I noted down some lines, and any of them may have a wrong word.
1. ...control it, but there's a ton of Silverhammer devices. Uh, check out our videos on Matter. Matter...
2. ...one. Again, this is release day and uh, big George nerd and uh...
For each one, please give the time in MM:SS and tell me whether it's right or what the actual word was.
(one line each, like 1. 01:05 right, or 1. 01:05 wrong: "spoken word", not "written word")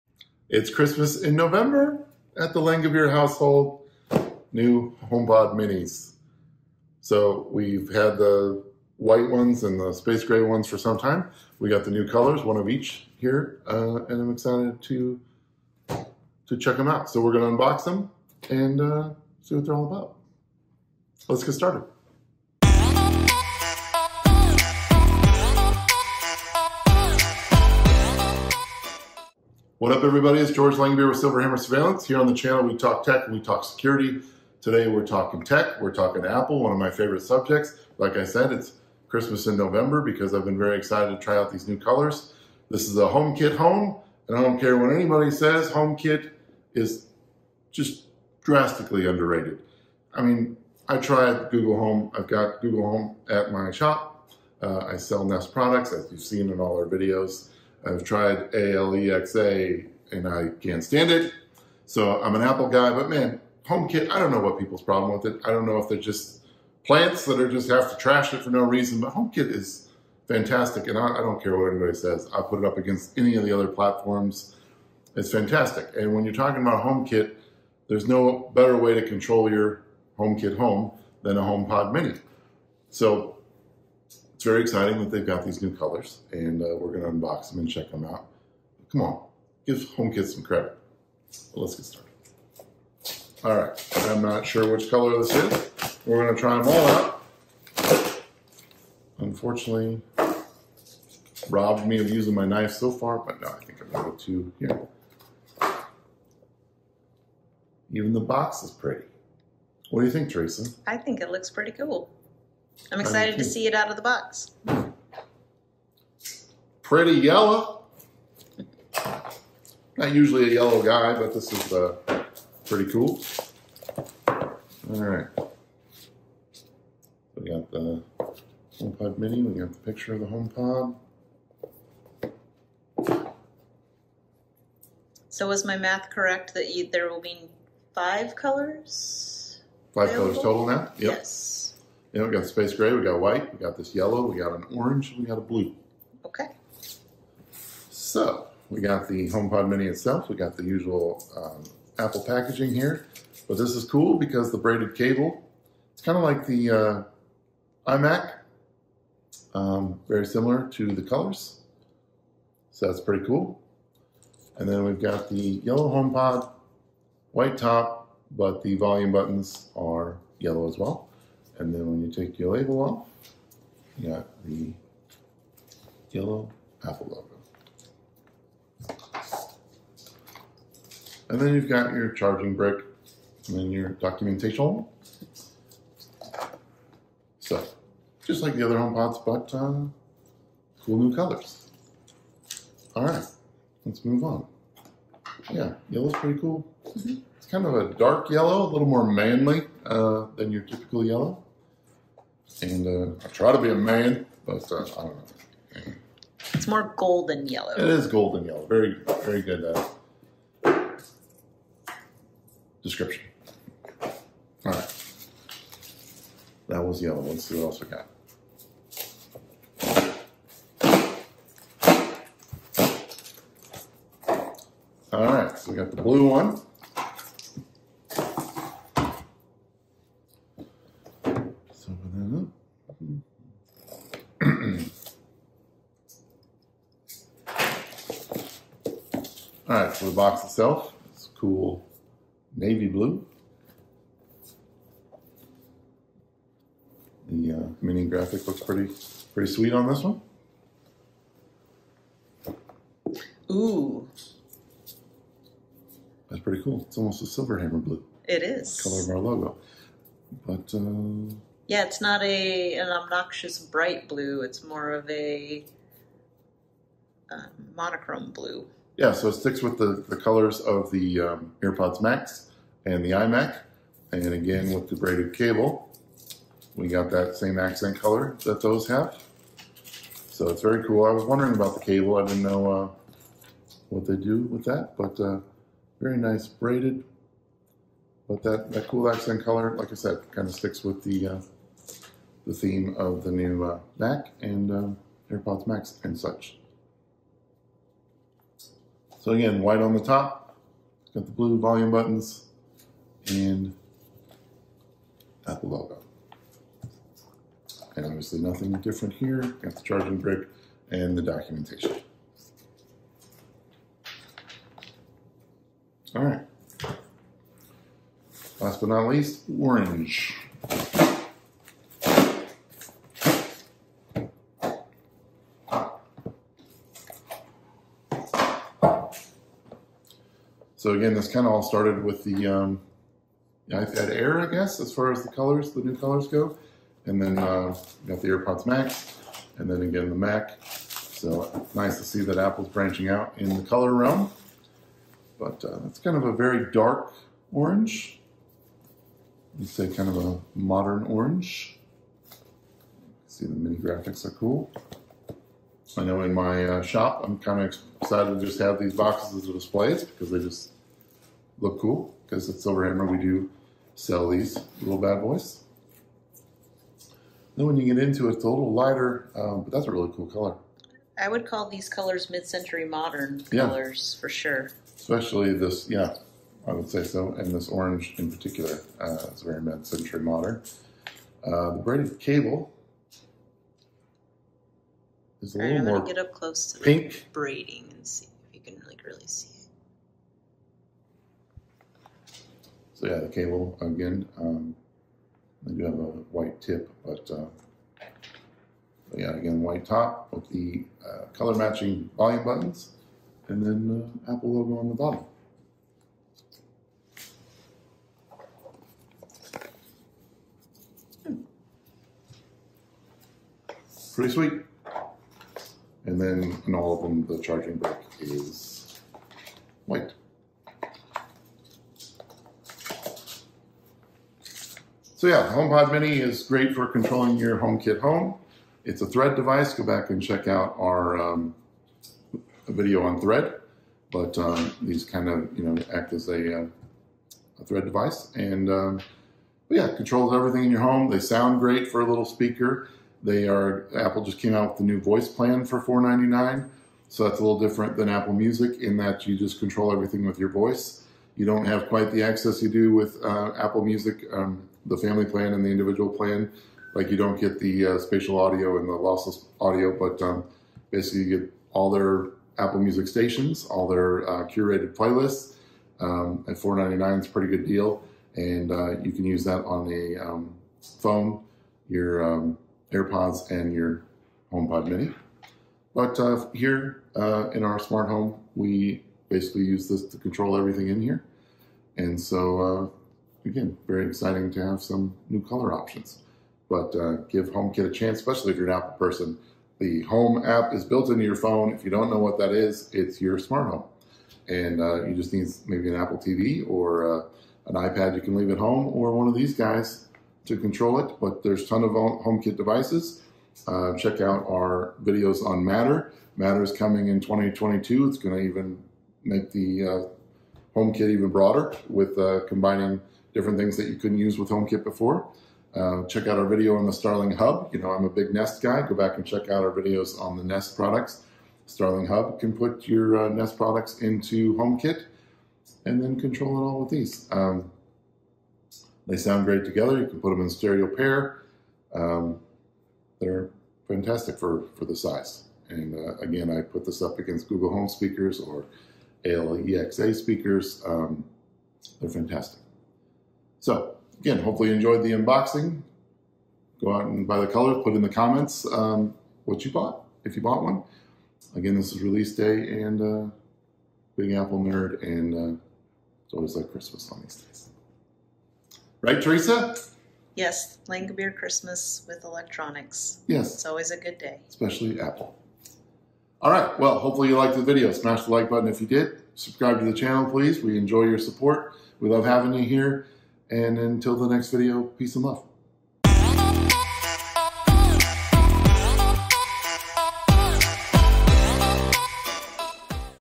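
1. 08:20 wrong: "HomeKit", not "Silverhammer"
2. 09:10 wrong: "Apple", not "George".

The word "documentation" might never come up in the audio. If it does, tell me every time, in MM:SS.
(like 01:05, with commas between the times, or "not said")
03:03, 05:11.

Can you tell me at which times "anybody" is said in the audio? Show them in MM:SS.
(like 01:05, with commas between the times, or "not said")
00:44, 01:11.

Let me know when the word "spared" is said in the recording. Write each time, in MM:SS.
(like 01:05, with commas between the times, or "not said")
not said.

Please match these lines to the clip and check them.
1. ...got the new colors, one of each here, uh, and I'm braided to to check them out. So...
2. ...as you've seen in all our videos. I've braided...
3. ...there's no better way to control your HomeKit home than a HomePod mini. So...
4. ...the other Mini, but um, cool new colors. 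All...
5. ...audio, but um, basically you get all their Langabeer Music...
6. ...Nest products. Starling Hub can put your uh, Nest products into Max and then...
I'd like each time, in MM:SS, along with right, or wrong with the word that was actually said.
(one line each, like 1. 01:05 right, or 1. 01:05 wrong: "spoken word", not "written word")
1. 00:11 wrong: "excited", not "braided"
2. 00:55 wrong: "tried", not "braided"
3. 01:17 right
4. 03:08 wrong: "HomePods", not "Mini"
5. 07:39 wrong: "Apple", not "Langabeer"
6. 08:40 wrong: "HomeKit", not "Max".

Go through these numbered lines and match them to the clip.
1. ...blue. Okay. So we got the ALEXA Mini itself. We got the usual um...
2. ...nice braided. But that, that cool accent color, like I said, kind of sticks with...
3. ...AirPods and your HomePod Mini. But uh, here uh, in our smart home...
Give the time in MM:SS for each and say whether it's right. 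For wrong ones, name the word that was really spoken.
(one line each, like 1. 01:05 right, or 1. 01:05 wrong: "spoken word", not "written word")
1. 02:25 wrong: "HomePod", not "ALEXA"
2. 04:46 right
3. 07:52 right.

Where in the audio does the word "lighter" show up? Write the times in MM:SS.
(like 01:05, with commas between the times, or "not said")
06:08.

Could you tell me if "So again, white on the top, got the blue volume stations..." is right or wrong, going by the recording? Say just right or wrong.
wrong.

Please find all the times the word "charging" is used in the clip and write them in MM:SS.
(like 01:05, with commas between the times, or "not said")
03:02, 05:09, 06:57.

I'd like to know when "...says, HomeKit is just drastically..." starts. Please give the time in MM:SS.
00:45.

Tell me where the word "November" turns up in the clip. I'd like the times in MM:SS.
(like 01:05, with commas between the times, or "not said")
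00:01, 00:39.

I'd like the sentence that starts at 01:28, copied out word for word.
Come on, give HomeKit some credit.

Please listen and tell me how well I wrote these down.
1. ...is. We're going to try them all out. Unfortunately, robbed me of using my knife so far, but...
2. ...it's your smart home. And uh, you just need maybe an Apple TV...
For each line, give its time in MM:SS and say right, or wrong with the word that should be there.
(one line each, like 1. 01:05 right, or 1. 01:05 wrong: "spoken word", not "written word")
1. 01:35 right
2. 08:12 right.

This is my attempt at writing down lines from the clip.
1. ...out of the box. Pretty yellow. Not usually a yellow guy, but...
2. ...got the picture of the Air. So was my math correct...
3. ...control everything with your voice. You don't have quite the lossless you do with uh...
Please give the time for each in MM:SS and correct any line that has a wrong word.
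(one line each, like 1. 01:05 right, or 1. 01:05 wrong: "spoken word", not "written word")
1. 01:53 right
2. 02:09 wrong: "HomePod", not "Air"
3. 07:29 wrong: "access", not "lossless".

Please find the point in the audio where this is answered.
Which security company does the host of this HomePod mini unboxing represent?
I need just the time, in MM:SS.
00:31.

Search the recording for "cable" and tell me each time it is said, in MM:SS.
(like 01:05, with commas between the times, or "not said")
02:34, 04:35, 04:41, 06:22, 06:33.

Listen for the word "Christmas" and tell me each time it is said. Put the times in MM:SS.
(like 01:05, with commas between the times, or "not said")
00:00, 00:39, 09:16, 09:21.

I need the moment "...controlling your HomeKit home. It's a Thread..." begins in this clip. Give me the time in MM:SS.
07:06.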